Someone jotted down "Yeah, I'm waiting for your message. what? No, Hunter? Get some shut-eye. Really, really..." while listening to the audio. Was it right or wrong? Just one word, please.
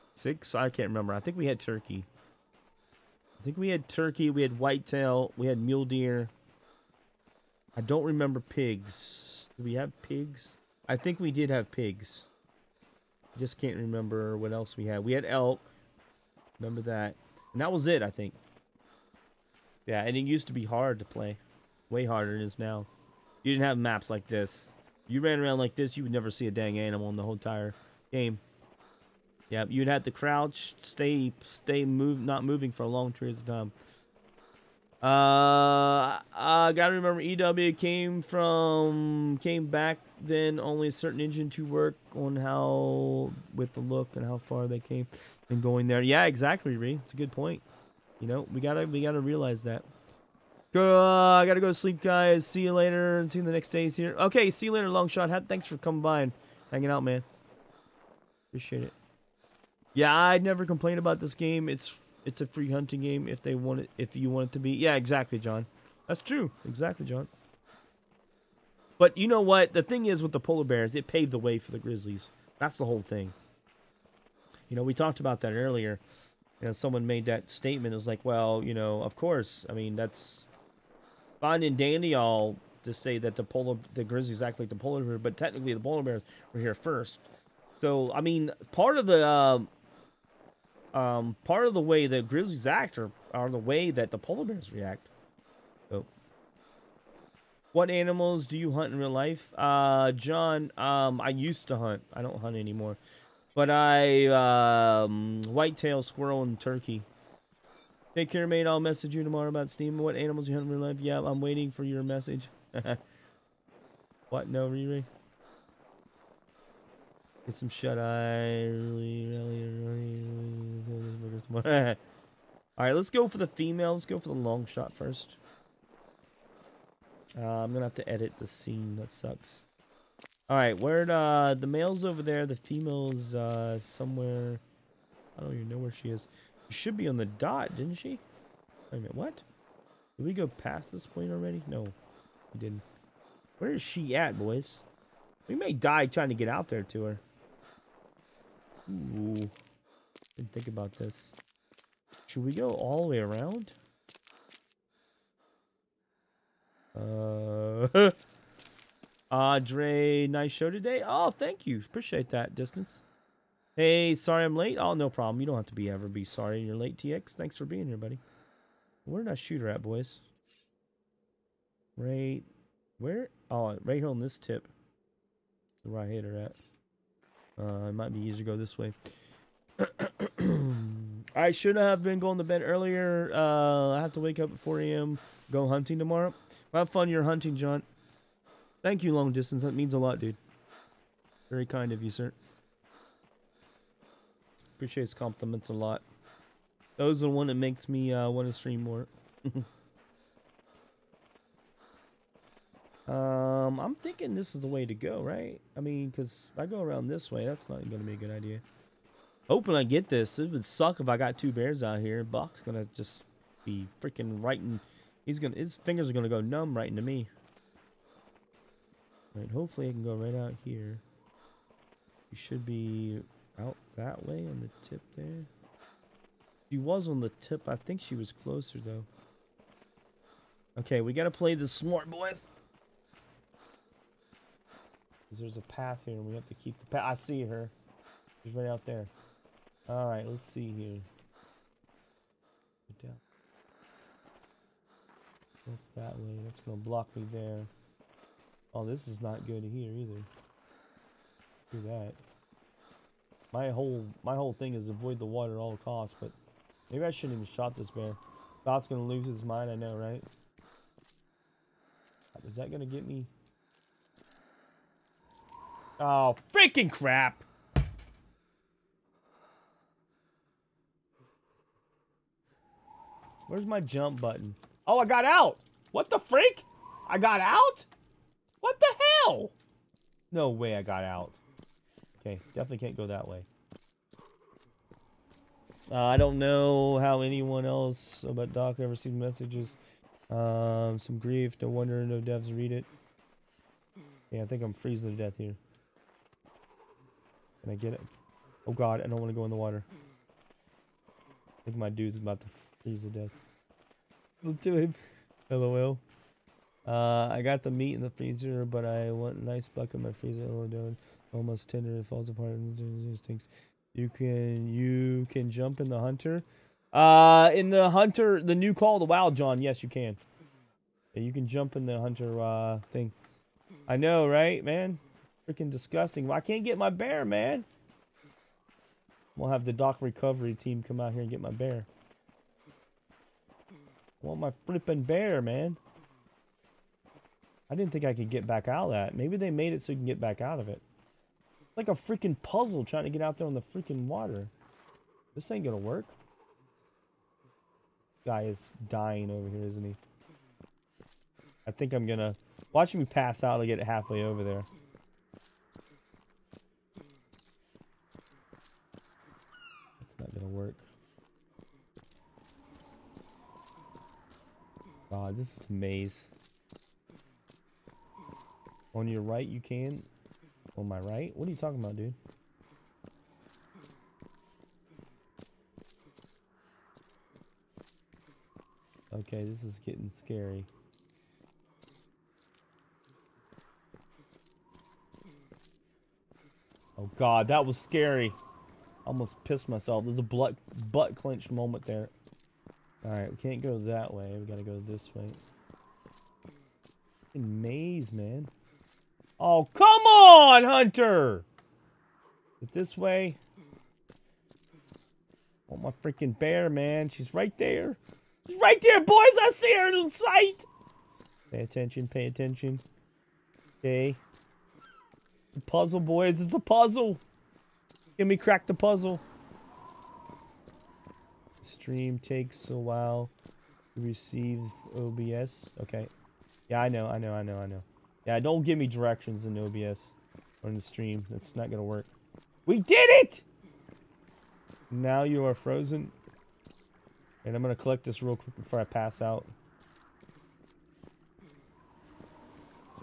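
wrong.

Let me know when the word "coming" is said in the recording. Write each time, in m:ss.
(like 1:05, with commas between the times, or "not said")
0:55.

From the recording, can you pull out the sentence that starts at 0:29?
Yeah, you'd have to crouch, stay, stay, move, not moving for a long periods of time.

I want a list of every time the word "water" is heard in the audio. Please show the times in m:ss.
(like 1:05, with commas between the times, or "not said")
4:15, 4:59, 5:44.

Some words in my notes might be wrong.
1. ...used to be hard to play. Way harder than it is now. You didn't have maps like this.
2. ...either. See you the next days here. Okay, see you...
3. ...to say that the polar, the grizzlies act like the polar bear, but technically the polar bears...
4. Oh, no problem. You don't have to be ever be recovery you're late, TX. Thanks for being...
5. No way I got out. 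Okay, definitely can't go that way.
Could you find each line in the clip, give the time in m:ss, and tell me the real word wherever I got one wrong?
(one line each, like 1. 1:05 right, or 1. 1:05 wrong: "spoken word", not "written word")
1. 0:20 right
2. 0:52 wrong: "later", not "either"
3. 1:22 right
4. 2:44 wrong: "sorry", not "recovery"
5. 4:40 right.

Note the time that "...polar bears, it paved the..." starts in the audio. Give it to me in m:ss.
1:10.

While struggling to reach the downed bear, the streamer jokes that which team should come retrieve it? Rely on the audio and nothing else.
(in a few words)
Dock recovery team.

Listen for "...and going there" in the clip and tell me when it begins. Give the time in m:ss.
0:45.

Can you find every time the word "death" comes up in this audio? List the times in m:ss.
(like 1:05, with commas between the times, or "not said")
4:55, 5:03.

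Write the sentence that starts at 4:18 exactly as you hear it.
Bot's gonna lose his mind, I know, right?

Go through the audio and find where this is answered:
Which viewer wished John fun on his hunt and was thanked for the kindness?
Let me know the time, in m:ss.
3:09.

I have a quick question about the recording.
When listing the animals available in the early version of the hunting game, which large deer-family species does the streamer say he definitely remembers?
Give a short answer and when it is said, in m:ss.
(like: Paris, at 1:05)
Elk, at 0:15.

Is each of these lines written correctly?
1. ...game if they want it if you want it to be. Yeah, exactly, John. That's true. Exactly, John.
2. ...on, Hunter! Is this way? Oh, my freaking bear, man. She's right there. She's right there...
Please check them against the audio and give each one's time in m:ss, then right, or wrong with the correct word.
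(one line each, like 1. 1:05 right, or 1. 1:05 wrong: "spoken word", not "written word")
1. 1:03 right
2. 6:40 right.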